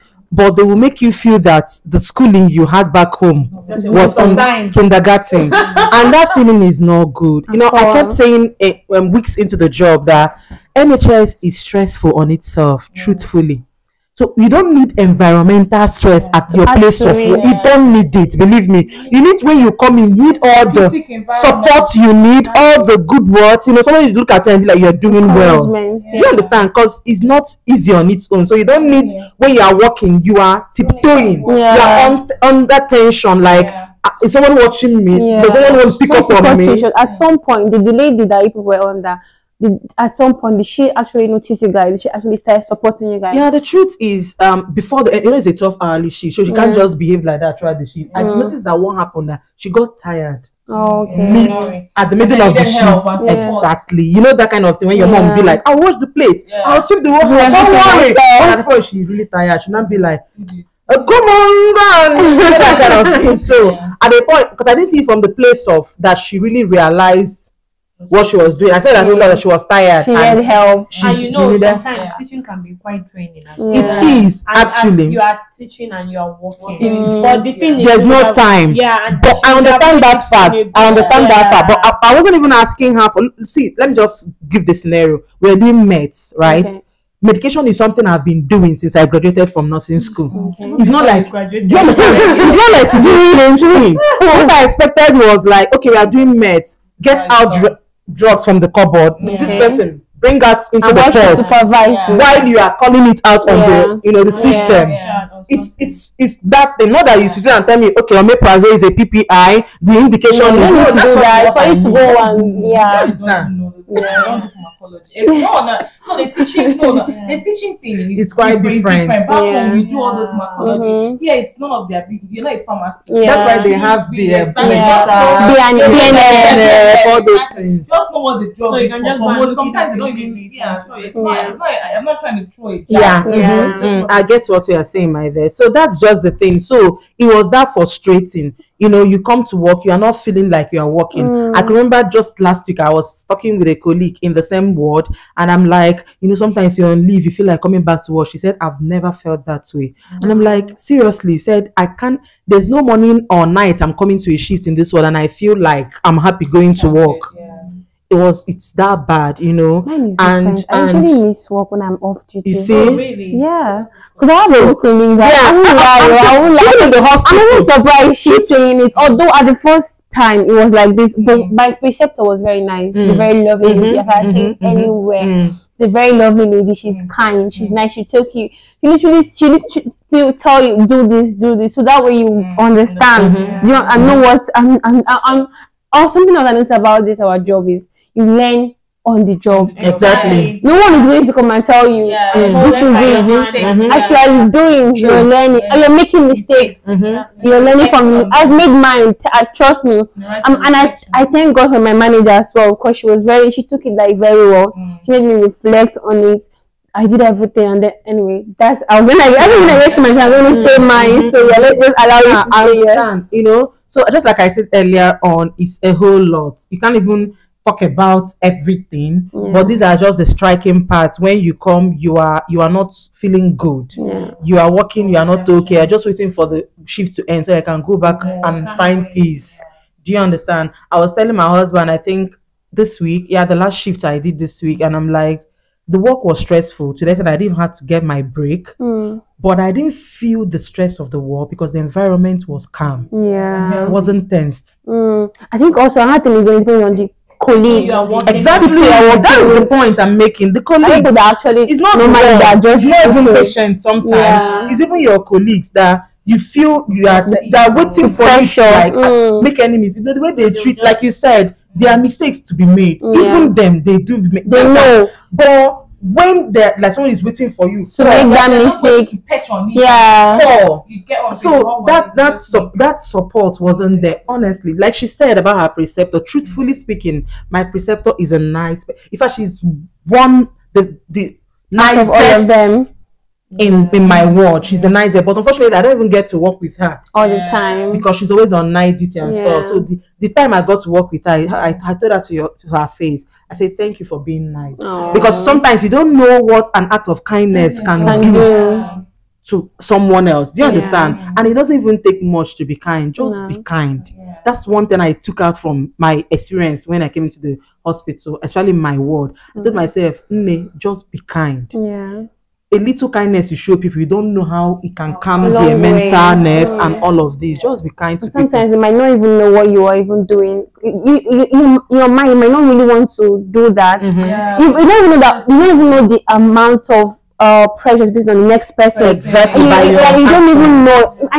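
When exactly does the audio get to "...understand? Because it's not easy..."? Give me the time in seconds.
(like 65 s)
26 s.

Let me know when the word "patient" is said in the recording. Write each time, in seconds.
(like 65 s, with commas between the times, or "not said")
253 s.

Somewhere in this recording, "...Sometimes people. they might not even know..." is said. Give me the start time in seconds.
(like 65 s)
318 s.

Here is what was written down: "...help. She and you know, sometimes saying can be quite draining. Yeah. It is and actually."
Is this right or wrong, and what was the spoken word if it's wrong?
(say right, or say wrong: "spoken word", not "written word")
wrong: "teaching", not "saying".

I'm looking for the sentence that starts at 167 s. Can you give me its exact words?
I'm even surprised she's saying it.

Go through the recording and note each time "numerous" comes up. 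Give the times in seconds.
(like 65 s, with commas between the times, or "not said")
not said.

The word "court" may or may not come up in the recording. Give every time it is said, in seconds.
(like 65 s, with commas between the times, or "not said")
101 s.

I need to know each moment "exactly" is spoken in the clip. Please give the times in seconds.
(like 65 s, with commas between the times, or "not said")
53 s, 124 s, 189 s, 248 s, 329 s.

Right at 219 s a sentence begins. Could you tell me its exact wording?
but these are just the striking parts when you come you are you are not feeling good yeah.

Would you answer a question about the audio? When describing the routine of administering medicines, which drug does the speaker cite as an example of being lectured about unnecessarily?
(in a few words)
Omeprazole.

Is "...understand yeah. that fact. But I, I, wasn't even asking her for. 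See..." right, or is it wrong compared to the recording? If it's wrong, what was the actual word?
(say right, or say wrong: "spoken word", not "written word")
right.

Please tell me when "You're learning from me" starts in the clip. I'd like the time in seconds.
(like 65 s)
197 s.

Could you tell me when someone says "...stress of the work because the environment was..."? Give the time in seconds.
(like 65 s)
240 s.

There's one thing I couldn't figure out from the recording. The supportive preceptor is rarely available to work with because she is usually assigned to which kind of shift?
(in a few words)
Night duty.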